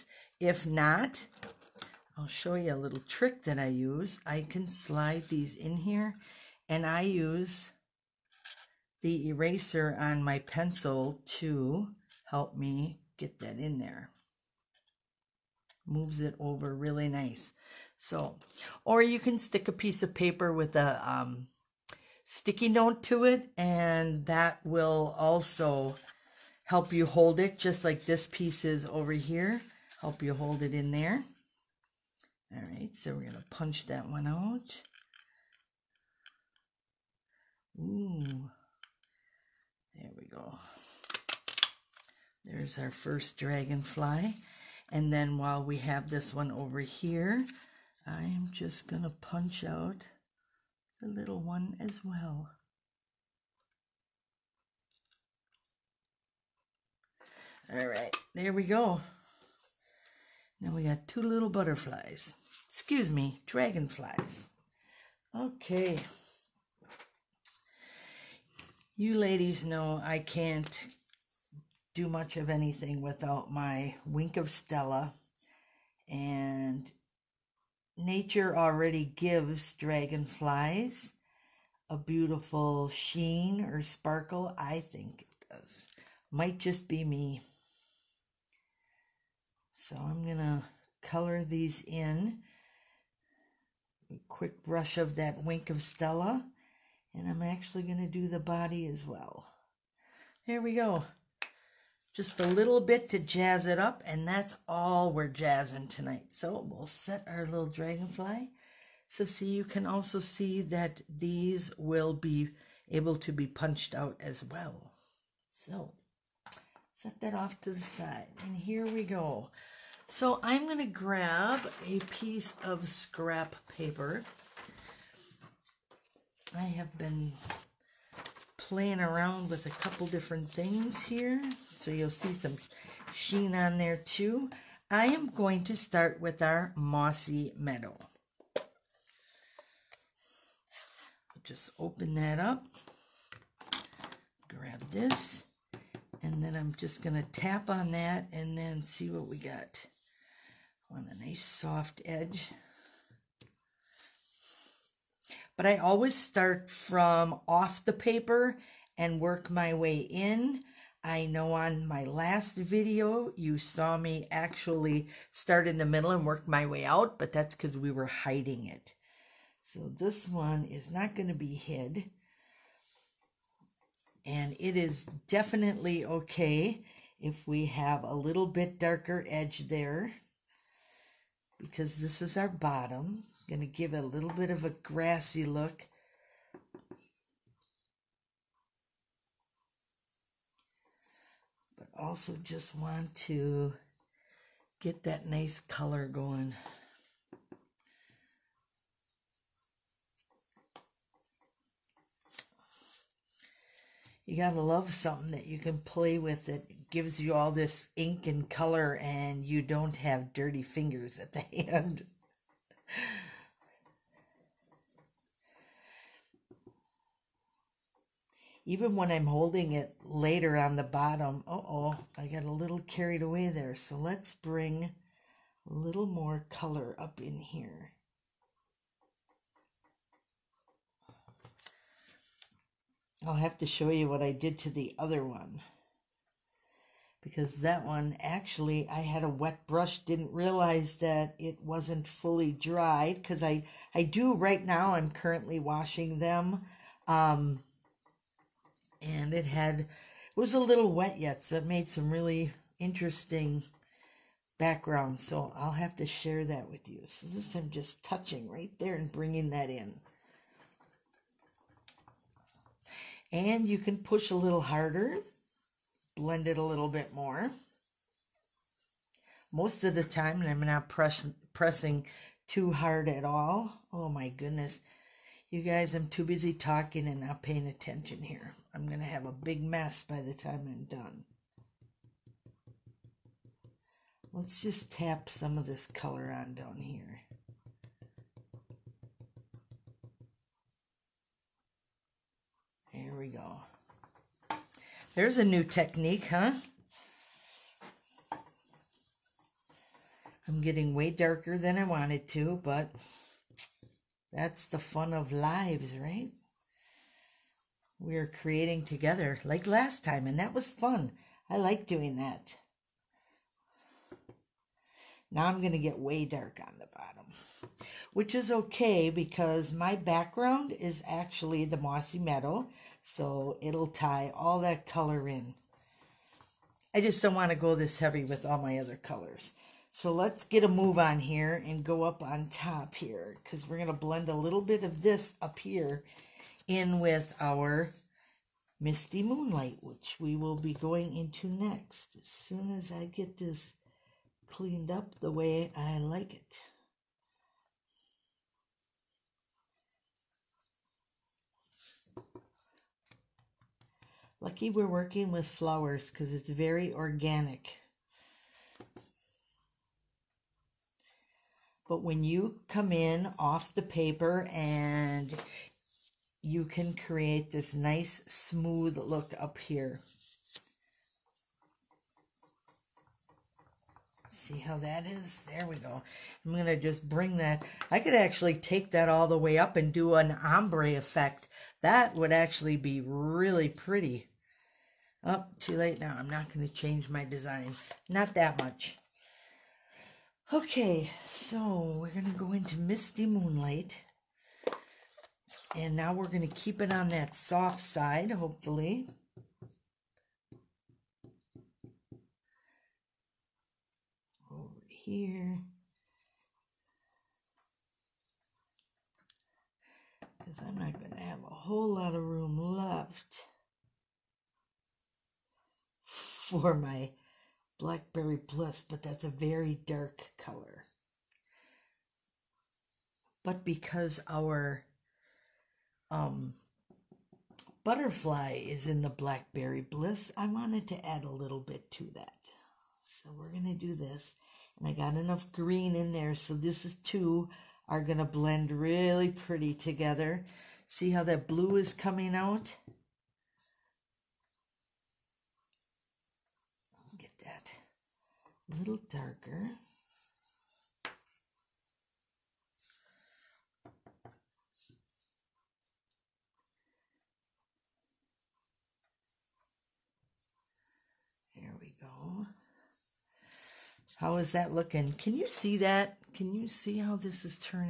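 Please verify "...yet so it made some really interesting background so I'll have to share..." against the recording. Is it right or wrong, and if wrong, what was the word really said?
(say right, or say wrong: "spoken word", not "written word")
right.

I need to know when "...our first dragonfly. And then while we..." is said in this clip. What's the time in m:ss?
0:42.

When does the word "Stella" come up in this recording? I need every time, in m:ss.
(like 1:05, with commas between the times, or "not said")
1:14, 1:35.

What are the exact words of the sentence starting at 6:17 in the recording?
I could actually take that all the way up and do an ombre effect.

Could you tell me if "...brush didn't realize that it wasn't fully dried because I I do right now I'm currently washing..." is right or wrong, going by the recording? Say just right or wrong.
right.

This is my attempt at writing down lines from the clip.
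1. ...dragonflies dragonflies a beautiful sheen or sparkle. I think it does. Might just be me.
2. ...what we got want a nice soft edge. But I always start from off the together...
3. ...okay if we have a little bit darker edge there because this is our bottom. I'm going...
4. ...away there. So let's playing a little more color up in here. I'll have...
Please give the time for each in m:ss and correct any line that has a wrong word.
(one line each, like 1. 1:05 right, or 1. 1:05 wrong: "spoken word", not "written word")
1. 1:19 wrong: "gives", not "dragonflies"
2. 2:29 wrong: "paper", not "together"
3. 2:56 right
4. 3:43 wrong: "bring", not "playing".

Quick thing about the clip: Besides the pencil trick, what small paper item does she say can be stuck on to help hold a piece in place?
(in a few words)
sticky note.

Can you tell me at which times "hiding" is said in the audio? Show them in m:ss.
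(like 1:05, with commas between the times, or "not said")
2:48.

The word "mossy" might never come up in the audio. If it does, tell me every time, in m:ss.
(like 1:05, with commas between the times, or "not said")
2:16, 5:21.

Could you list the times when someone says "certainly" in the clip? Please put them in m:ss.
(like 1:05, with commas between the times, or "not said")
not said.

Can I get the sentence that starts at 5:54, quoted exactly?
Lucky we're working with flowers because it's very organic.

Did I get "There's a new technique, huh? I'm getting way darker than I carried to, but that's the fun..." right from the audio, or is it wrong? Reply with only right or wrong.
wrong.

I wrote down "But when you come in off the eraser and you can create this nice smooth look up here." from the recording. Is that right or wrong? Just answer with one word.
wrong.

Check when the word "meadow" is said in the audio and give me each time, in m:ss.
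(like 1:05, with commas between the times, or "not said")
2:17, 5:22.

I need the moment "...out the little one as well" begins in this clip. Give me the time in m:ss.
0:49.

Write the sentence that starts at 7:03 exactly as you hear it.
But because our um, butterfly is in the Blackberry Bliss, I wanted to add a little bit to that.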